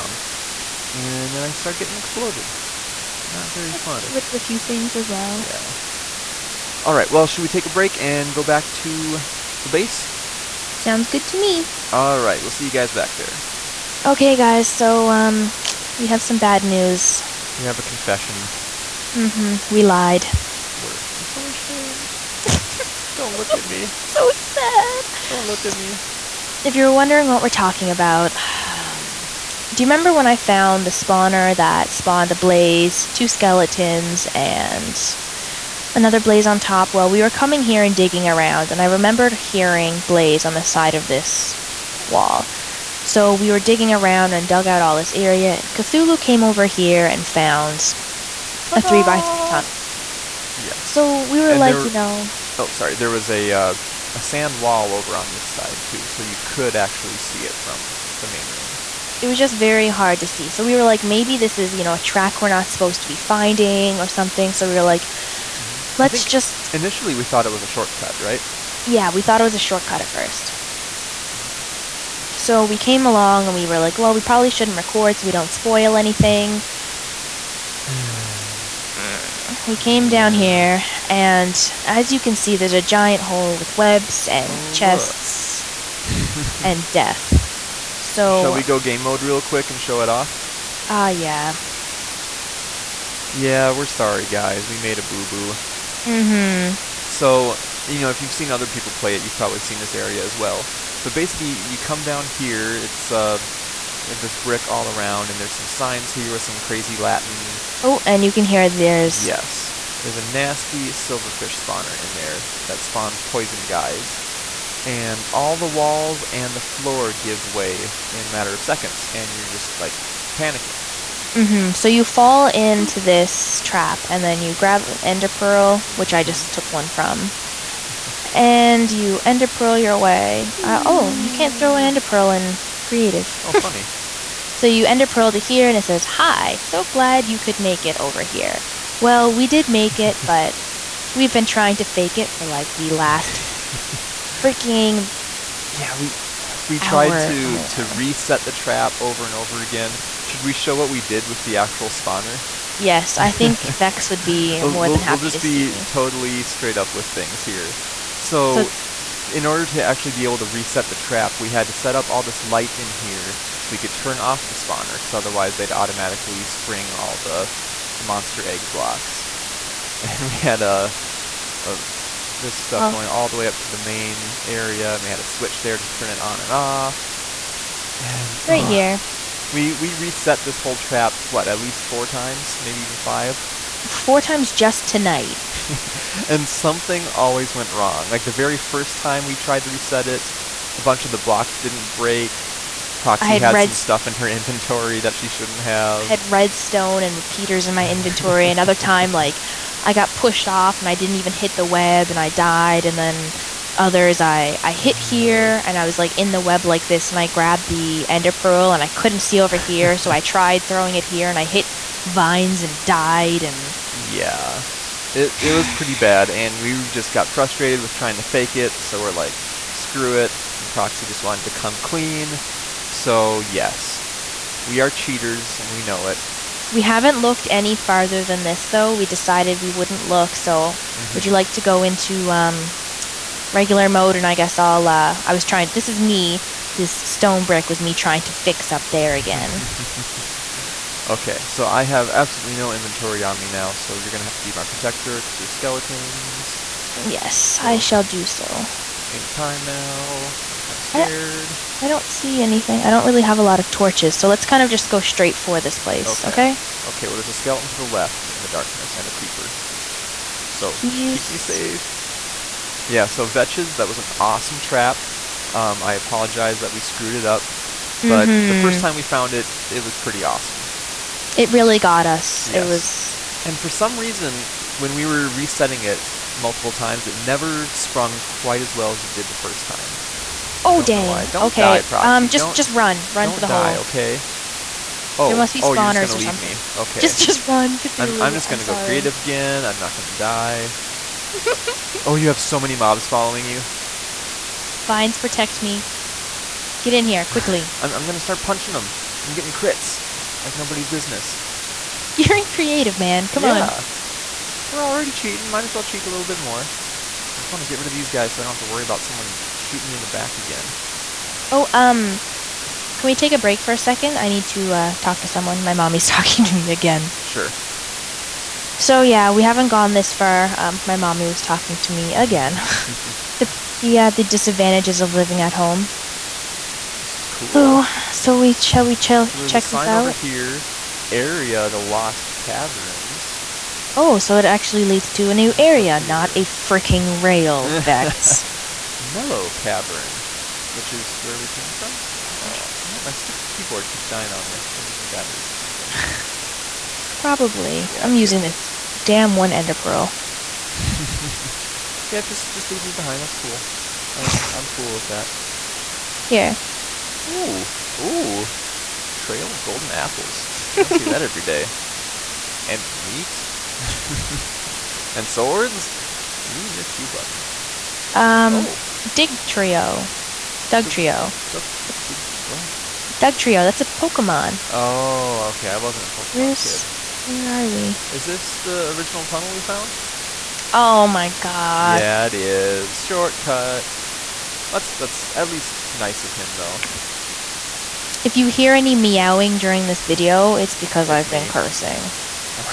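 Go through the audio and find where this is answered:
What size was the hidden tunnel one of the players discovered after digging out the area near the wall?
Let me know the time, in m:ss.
0:48.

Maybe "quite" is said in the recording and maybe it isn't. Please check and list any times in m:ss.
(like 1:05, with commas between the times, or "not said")
4:38.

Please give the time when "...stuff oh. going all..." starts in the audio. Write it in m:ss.
2:52.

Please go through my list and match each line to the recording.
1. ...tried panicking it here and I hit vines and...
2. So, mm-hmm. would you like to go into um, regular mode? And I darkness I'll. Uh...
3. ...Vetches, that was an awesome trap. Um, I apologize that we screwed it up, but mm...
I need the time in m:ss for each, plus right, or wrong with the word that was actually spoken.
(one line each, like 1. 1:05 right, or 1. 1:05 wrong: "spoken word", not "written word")
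1. 3:30 wrong: "throwing", not "panicking"
2. 3:50 wrong: "guess", not "darkness"
3. 4:23 right.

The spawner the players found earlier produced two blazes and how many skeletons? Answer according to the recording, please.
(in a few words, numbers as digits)
2.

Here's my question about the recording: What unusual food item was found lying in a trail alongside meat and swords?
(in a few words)
golden apples.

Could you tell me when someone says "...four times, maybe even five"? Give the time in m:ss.
3:01.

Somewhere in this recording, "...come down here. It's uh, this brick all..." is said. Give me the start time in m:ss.
1:41.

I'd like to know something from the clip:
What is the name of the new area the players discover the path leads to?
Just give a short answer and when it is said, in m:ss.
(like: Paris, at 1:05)
the Lost Caverns, at 5:31.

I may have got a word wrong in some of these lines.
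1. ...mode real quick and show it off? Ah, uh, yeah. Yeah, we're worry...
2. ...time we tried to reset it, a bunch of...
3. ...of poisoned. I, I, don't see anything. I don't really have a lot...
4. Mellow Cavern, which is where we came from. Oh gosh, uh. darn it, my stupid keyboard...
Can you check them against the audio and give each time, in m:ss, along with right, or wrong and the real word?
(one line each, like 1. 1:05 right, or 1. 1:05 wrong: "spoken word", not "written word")
1. 1:29 wrong: "sorry", not "worry"
2. 3:08 right
3. 4:10 wrong: "scared", not "poisoned"
4. 5:38 right.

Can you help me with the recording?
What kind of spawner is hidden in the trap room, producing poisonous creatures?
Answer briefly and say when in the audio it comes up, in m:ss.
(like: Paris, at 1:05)
Silverfish spawner, at 1:50.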